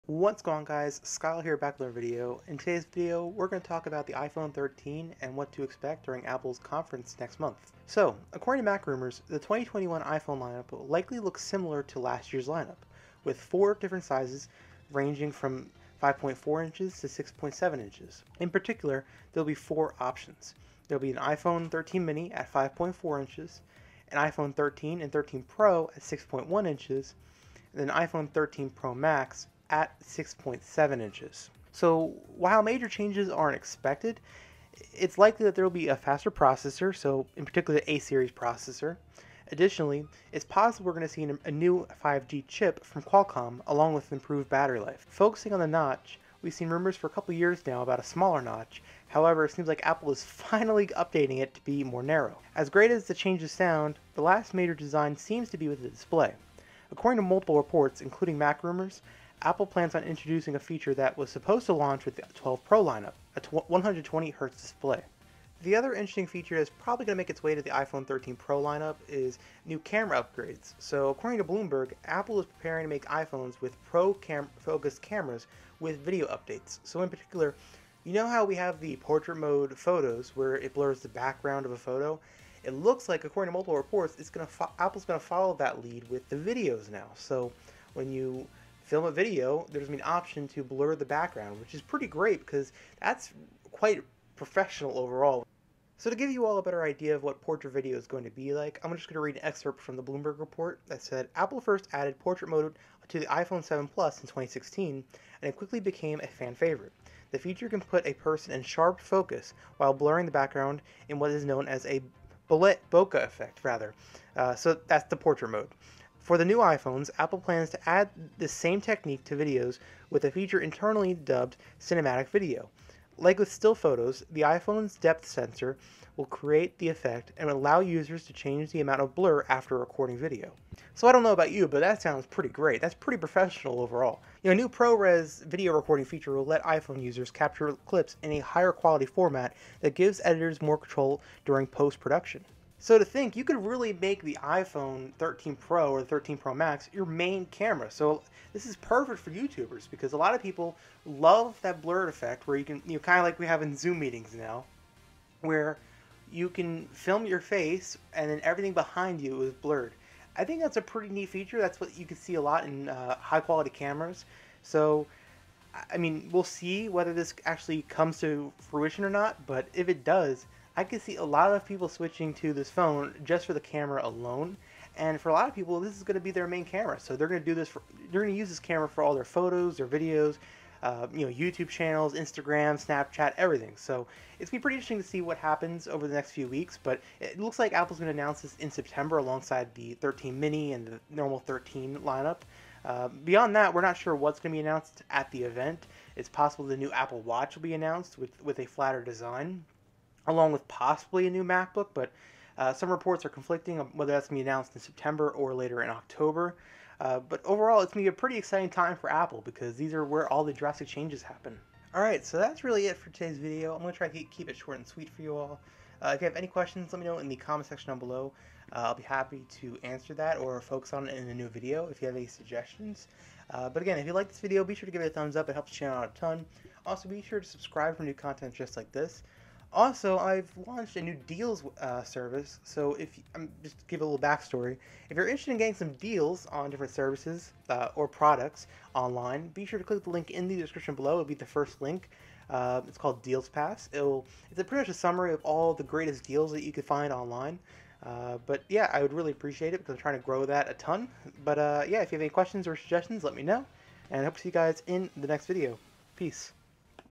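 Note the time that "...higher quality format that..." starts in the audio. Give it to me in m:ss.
2:18.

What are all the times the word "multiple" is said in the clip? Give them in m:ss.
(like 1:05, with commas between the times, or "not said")
0:57, 1:23.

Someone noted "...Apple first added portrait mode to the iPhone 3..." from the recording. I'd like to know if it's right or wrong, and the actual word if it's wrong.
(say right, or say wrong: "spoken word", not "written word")
wrong: "7", not "3".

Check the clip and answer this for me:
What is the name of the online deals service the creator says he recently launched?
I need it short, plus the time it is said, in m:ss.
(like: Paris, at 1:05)
DealsPass, at 4:03.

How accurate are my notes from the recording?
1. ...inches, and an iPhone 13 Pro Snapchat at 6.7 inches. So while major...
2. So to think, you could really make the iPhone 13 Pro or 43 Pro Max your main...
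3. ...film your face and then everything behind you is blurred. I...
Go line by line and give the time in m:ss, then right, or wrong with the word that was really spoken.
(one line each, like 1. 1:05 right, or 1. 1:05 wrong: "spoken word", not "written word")
1. 0:26 wrong: "Max", not "Snapchat"
2. 2:22 wrong: "13", not "43"
3. 2:36 right.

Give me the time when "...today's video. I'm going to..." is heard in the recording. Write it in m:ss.
3:33.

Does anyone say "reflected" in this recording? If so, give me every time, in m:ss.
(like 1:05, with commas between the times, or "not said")
not said.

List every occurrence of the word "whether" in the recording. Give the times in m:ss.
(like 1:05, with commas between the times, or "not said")
2:46, 3:23.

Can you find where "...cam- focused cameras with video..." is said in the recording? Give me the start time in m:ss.
1:14.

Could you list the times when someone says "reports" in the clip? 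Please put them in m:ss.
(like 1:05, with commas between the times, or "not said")
0:57, 1:23, 1:40, 3:22.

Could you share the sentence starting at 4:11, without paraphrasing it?
But uh, yeah, if you have any questions or suggestions, let me know.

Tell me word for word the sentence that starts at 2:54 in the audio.
And for a lot of people, this is going to be their main camera.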